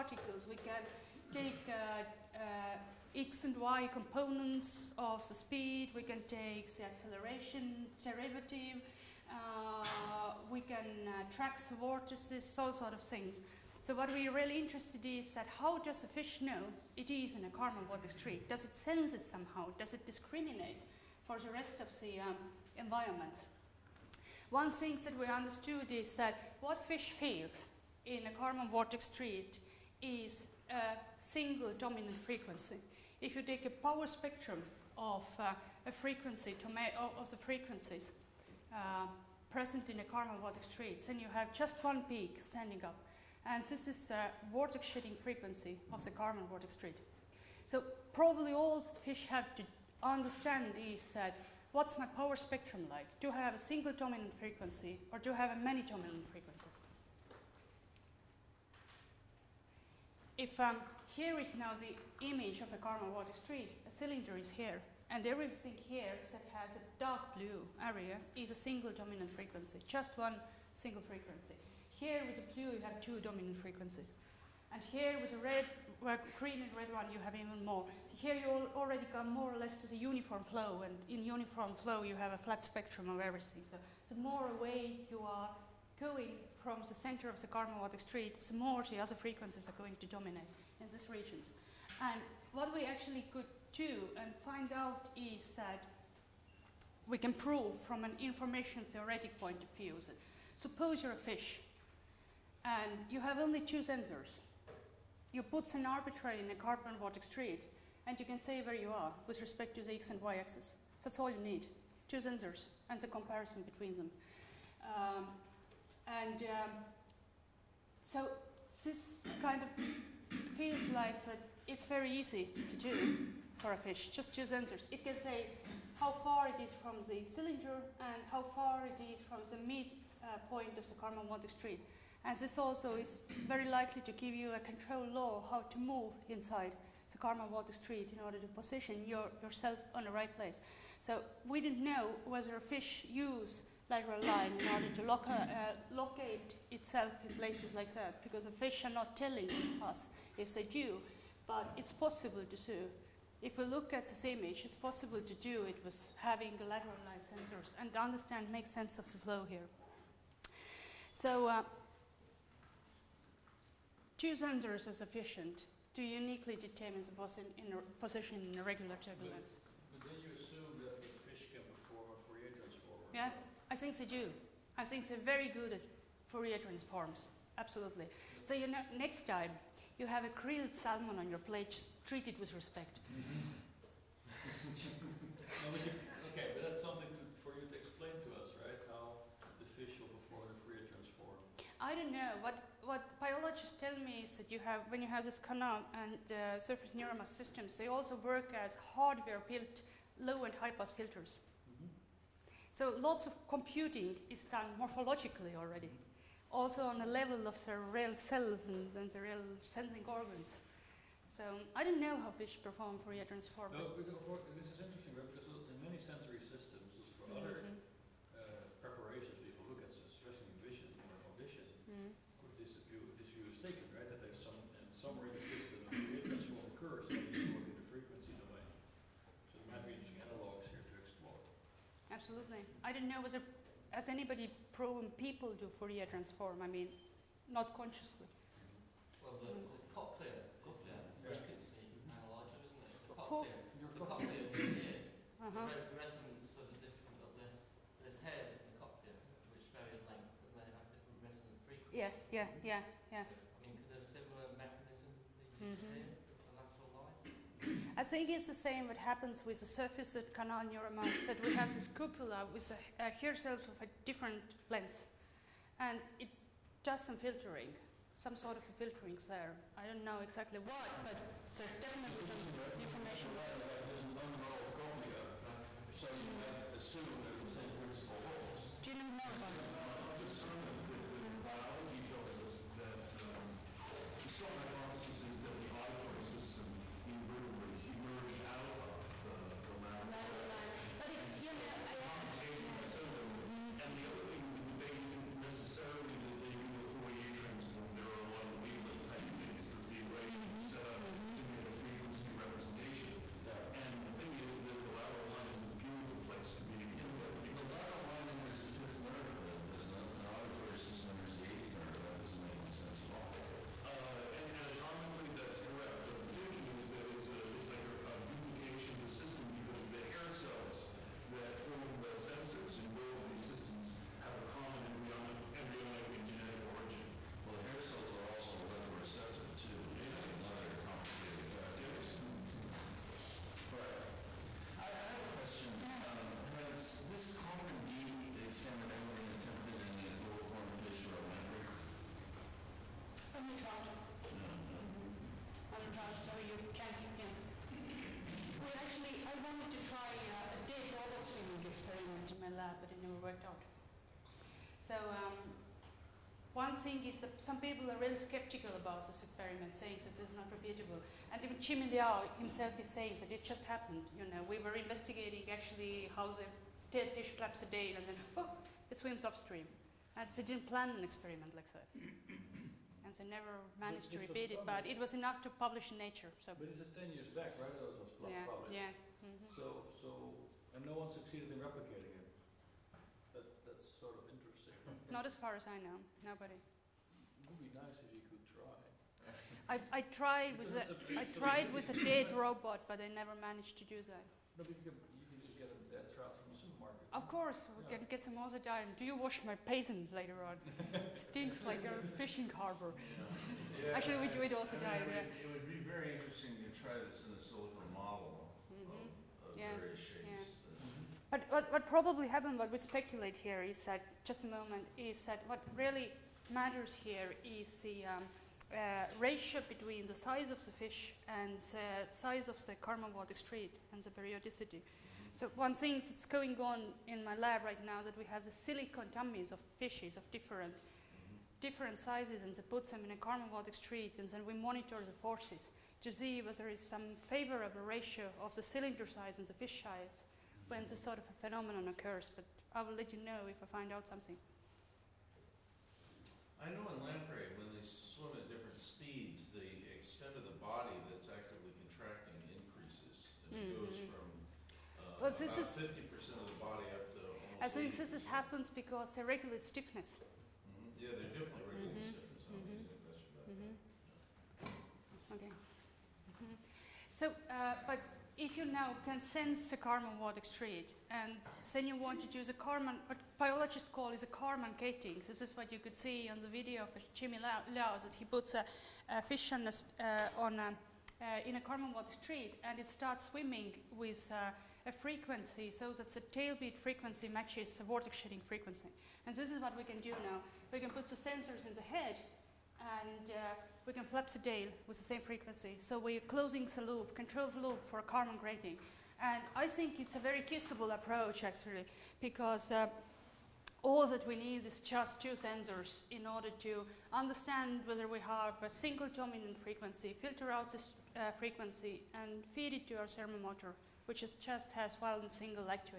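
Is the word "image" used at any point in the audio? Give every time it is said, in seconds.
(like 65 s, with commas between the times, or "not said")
62 s, 154 s.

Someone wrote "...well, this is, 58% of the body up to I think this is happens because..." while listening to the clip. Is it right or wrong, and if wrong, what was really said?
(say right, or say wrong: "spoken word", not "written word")
wrong: "50", not "58".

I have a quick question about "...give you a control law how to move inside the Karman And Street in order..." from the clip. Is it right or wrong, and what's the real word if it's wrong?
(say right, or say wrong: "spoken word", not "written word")
wrong: "Vortex", not "And".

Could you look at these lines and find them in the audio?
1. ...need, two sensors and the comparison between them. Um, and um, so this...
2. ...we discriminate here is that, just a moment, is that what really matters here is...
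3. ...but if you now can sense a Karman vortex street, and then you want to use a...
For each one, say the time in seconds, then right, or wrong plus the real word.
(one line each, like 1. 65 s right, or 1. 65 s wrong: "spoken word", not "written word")
1. 111 s right
2. 412 s wrong: "speculate", not "discriminate"
3. 467 s right.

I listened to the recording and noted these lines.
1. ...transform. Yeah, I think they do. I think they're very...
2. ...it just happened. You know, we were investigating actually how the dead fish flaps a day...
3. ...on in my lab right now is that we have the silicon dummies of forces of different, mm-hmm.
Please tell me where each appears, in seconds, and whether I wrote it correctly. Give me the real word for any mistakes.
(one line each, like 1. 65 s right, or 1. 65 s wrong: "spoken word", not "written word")
1. 172 s right
2. 363 s right
3. 426 s wrong: "fishes", not "forces".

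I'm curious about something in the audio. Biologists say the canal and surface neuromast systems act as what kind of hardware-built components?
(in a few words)
low and high pass filters.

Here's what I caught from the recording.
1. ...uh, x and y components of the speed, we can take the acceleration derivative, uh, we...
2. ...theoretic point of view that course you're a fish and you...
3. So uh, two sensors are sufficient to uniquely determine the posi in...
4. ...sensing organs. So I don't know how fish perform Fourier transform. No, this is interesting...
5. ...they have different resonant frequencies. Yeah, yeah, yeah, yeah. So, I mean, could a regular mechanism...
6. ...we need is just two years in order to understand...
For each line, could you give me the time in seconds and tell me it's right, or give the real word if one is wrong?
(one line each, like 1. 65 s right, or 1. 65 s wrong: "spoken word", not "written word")
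1. 2 s right
2. 98 s wrong: "suppose", not "course"
3. 161 s right
4. 209 s right
5. 250 s wrong: "similar", not "regular"
6. 504 s wrong: "sensors", not "years".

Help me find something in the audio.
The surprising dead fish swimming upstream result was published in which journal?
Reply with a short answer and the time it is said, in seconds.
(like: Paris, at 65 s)
Nature, at 375 s.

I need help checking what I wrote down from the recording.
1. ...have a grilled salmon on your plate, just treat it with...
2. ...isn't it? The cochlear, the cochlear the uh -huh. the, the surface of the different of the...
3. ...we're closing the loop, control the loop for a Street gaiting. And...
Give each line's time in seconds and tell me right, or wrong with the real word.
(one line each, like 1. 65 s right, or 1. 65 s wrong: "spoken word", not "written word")
1. 180 s right
2. 242 s wrong: "resonance", not "surface"
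3. 495 s wrong: "Karman", not "Street".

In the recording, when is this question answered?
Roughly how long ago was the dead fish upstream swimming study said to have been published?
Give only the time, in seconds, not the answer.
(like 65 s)
376 s.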